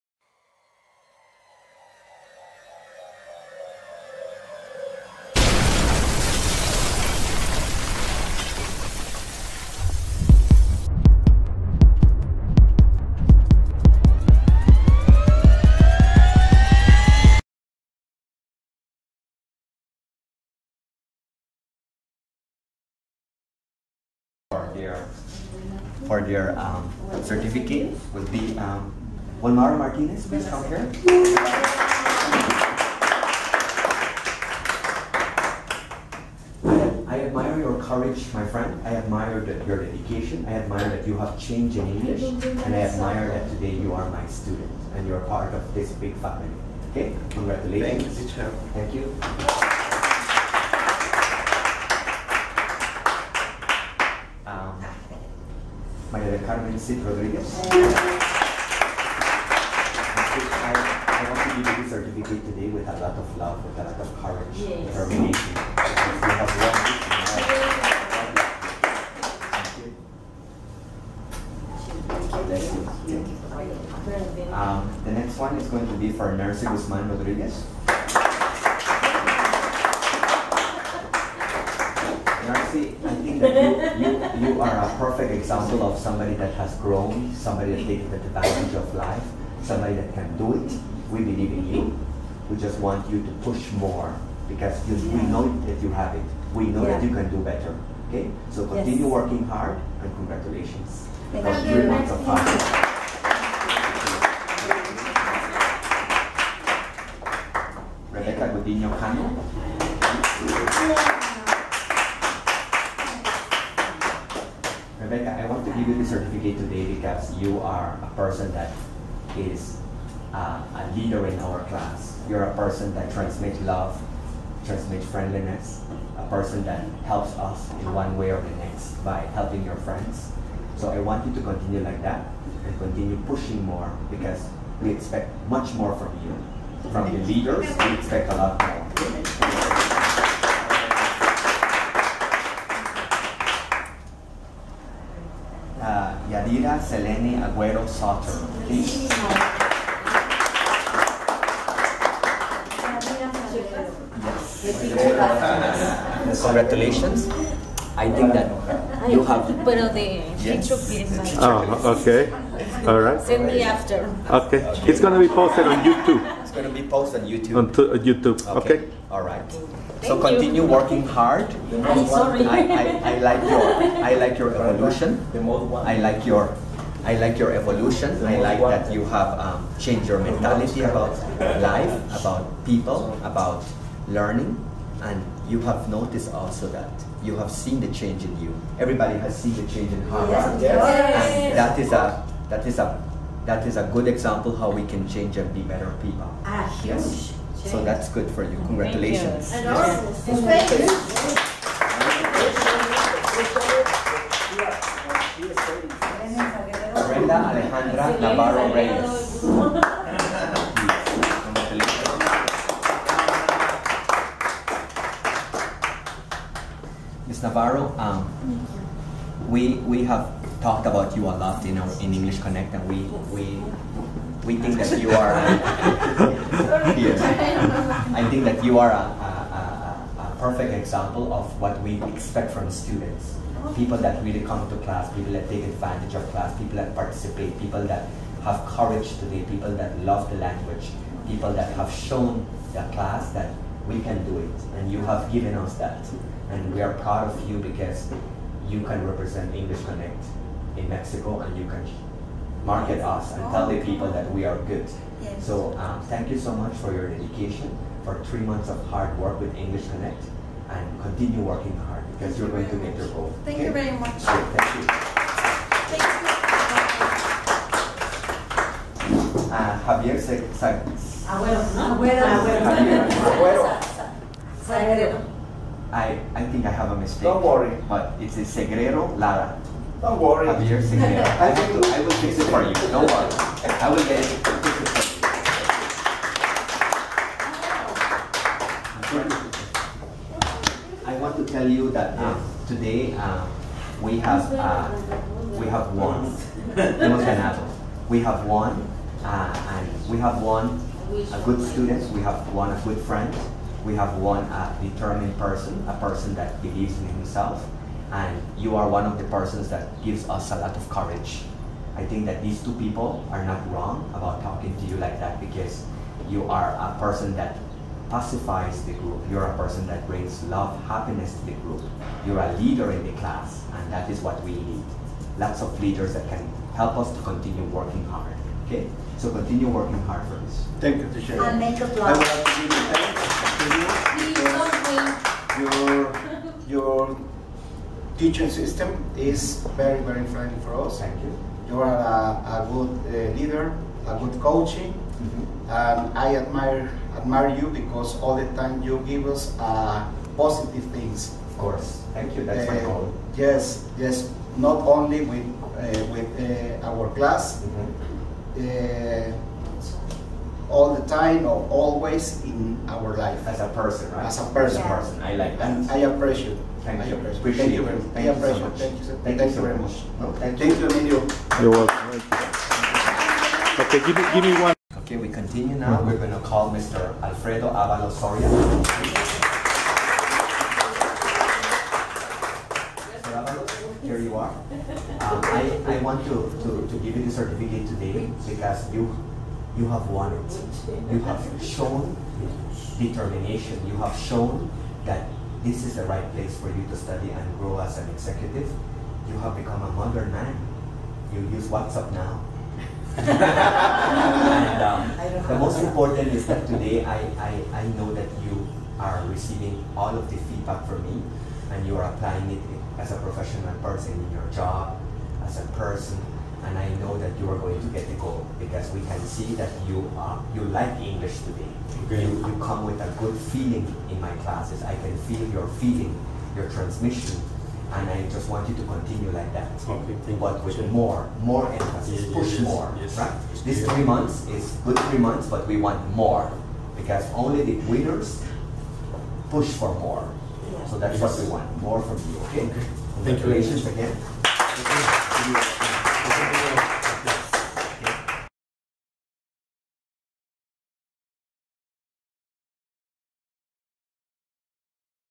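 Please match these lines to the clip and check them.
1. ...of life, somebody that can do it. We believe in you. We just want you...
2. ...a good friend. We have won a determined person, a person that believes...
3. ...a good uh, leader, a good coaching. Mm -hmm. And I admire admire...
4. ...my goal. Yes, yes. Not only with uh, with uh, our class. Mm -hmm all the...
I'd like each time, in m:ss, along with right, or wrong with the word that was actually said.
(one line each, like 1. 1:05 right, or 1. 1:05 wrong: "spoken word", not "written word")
1. 1:28 right
2. 5:02 right
3. 5:42 right
4. 5:52 right.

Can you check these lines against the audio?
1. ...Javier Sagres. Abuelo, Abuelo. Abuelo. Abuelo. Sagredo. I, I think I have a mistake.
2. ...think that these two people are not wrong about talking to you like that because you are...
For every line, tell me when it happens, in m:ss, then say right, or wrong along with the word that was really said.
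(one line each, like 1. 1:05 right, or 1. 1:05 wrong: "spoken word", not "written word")
1. 4:29 right
2. 5:12 right.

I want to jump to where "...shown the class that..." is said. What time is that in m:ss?
4:01.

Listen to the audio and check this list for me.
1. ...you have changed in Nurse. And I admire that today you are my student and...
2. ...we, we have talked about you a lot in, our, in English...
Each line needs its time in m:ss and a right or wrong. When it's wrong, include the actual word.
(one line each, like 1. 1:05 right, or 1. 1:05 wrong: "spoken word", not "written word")
1. 0:41 wrong: "English", not "Nurse"
2. 3:39 right.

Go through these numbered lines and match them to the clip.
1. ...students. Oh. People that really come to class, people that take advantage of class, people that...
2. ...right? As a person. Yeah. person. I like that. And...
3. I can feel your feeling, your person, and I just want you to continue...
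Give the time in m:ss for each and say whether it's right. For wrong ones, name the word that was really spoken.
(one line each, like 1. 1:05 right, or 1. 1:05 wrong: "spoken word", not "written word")
1. 3:52 right
2. 6:04 right
3. 7:04 wrong: "transmission", not "person".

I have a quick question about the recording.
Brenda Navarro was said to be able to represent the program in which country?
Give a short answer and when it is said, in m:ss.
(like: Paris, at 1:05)
Mexico, at 4:10.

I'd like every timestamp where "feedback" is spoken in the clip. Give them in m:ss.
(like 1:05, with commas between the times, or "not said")
6:50.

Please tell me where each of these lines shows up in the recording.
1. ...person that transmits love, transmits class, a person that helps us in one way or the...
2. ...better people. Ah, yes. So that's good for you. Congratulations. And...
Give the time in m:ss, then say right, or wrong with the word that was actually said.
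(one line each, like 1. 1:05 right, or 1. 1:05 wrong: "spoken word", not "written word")
1. 2:02 wrong: "friendliness", not "class"
2. 3:15 right.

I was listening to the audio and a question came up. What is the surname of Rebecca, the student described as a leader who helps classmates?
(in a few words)
Godinho Cano.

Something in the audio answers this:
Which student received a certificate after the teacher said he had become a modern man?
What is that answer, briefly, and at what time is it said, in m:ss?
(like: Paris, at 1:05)
Alfredo Avalos Soria, at 6:17.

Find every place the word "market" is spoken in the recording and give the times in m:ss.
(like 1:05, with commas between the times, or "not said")
4:12.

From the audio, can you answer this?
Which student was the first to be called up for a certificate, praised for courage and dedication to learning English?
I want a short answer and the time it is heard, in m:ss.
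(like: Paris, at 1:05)
Wilmar Martinez, at 0:29.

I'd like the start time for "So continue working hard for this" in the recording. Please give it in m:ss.
5:29.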